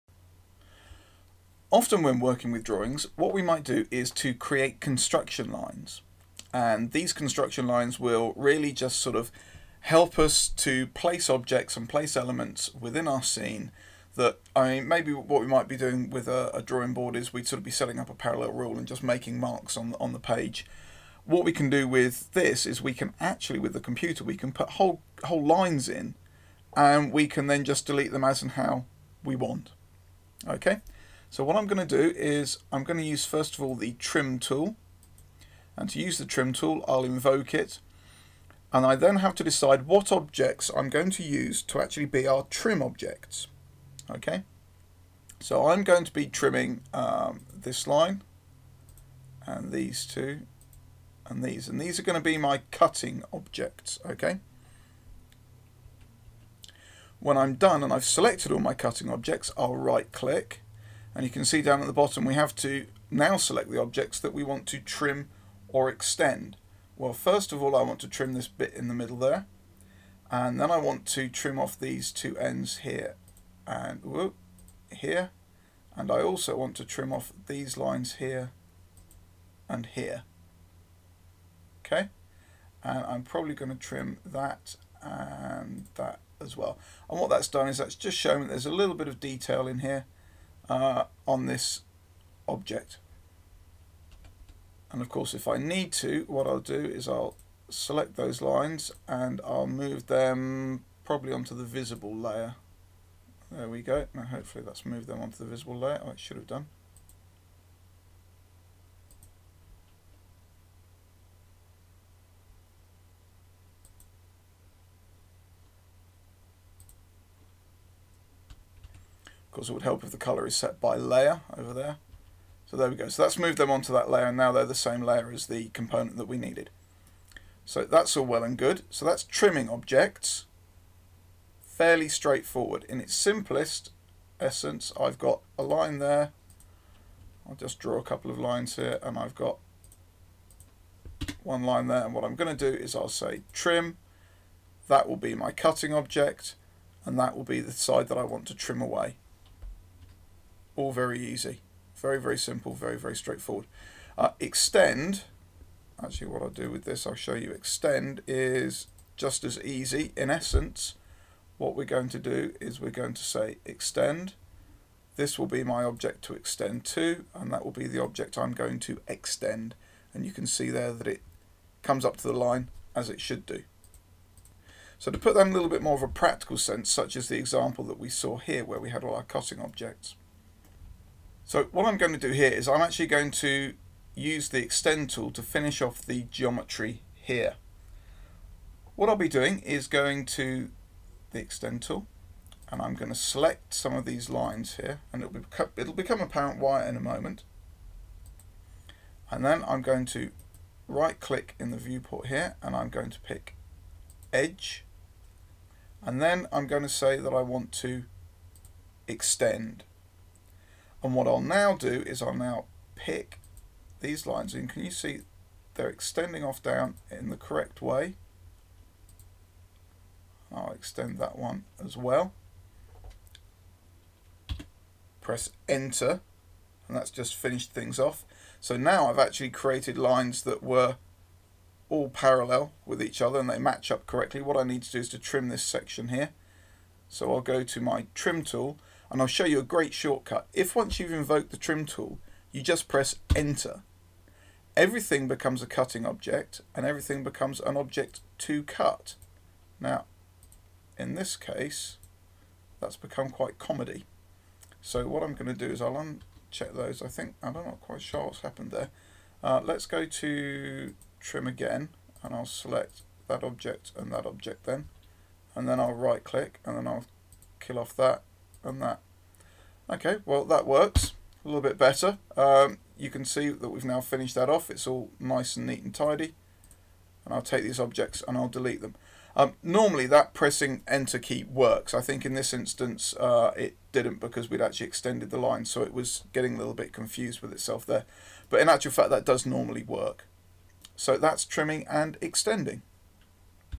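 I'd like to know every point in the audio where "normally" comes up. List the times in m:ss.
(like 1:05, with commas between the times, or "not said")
4:39, 4:49.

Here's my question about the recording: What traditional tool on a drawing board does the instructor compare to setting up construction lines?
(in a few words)
parallel rule.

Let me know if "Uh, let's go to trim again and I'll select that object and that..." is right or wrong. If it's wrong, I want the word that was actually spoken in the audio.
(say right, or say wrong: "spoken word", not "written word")
right.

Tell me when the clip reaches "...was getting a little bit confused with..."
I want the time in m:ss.
4:45.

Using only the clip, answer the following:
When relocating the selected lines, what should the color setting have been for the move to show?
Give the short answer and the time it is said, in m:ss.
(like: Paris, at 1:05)
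by layer, at 2:00.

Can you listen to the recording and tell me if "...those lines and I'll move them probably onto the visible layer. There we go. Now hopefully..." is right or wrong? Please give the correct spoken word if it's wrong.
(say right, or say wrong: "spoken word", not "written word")
right.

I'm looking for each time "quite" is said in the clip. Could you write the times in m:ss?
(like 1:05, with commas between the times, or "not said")
4:13, 4:17.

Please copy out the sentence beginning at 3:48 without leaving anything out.
So now I've actually created lines that were all parallel with each other and they match up correctly.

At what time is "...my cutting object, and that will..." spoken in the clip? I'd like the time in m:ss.
2:25.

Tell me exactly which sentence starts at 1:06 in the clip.
Well, first of all, I want to trim this bit in the middle there.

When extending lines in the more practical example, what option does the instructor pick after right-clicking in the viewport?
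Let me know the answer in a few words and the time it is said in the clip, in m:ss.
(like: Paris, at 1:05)
edge, at 3:24.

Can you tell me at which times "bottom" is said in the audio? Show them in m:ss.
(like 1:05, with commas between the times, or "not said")
1:01.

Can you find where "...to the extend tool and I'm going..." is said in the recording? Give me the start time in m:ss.
3:10.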